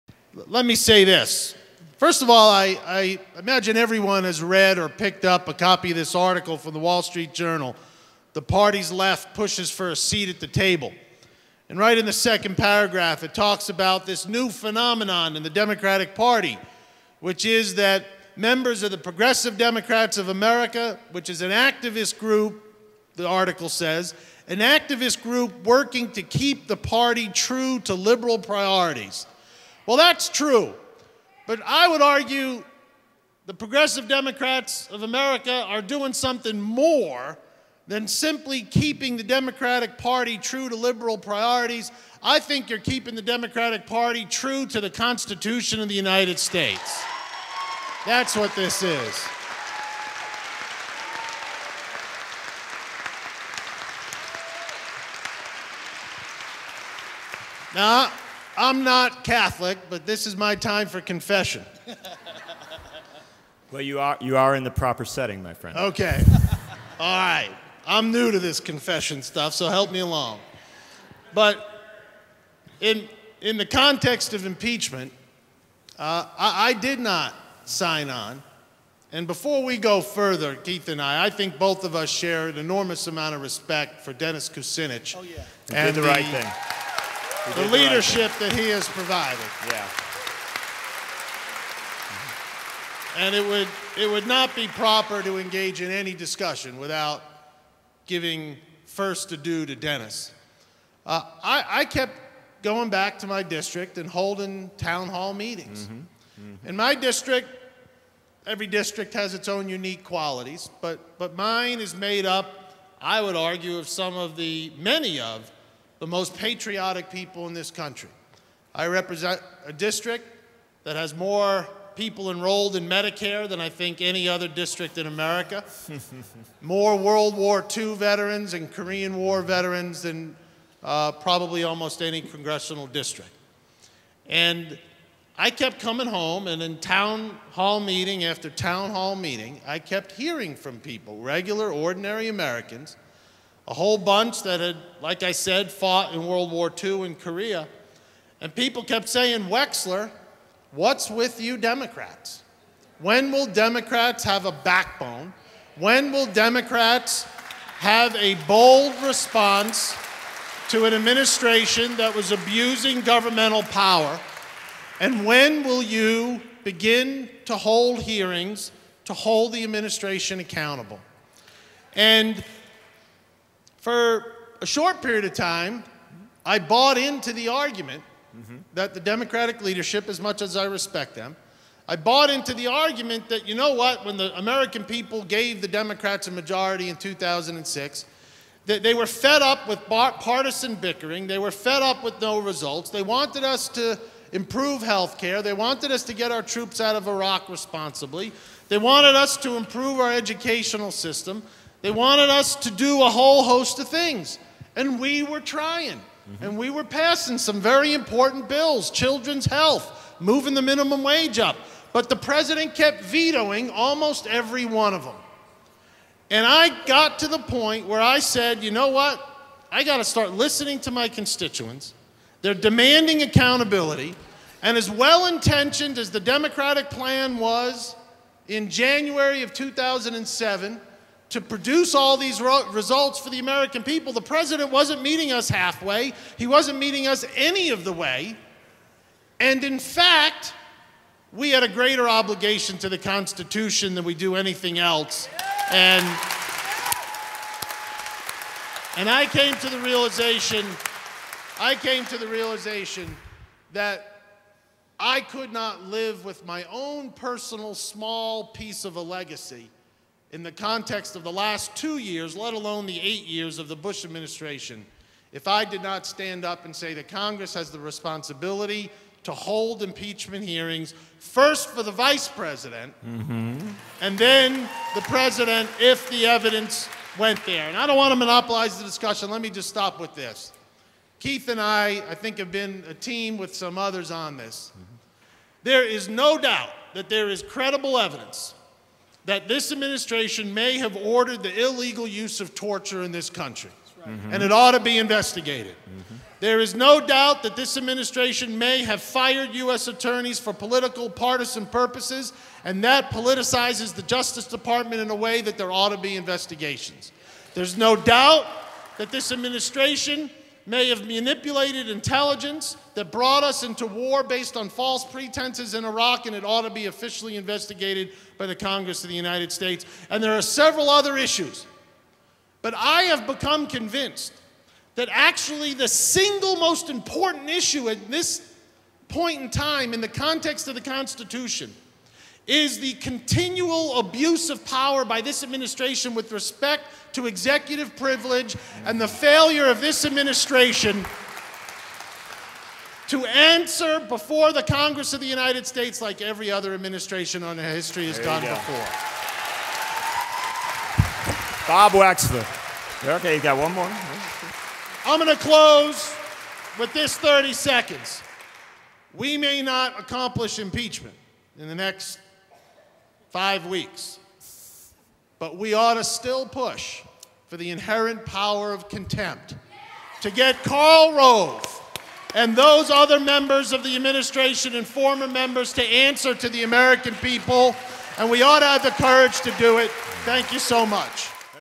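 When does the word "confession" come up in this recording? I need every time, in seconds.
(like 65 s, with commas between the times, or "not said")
61 s, 68 s.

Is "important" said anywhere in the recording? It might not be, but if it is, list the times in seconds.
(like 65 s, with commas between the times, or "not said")
207 s, 326 s.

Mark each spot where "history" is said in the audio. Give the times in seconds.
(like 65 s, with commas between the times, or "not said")
347 s.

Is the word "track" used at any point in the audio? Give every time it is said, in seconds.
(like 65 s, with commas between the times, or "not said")
not said.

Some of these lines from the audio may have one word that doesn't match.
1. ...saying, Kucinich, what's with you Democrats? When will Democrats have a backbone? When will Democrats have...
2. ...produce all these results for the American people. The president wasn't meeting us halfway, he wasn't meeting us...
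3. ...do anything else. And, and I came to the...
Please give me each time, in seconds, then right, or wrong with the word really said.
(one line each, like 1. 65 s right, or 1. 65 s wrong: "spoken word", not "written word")
1. 149 s wrong: "Wexler", not "Kucinich"
2. 231 s right
3. 244 s right.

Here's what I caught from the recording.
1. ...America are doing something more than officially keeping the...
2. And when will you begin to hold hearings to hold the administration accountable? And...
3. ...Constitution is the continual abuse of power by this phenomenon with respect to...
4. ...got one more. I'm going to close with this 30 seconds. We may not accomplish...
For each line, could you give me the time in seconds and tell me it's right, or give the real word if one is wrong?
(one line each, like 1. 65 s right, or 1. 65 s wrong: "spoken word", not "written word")
1. 35 s wrong: "simply", not "officially"
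2. 164 s right
3. 330 s wrong: "administration", not "phenomenon"
4. 353 s right.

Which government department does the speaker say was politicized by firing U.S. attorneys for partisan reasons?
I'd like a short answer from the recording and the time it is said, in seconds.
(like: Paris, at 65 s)
Justice Department, at 304 s.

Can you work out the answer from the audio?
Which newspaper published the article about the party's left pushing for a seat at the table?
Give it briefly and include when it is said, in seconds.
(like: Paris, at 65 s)
Wall Street Journal, at 6 s.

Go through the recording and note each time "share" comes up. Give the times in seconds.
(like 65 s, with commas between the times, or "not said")
82 s.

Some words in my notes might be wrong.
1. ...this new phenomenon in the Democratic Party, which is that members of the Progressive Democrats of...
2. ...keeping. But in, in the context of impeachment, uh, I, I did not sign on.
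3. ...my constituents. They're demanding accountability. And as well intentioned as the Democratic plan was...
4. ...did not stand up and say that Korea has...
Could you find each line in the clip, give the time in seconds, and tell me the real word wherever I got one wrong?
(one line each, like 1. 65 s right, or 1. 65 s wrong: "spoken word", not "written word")
1. 14 s right
2. 70 s wrong: "along", not "keeping"
3. 220 s right
4. 265 s wrong: "Congress", not "Korea".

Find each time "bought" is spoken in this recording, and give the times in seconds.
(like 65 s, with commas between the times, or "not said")
176 s, 181 s.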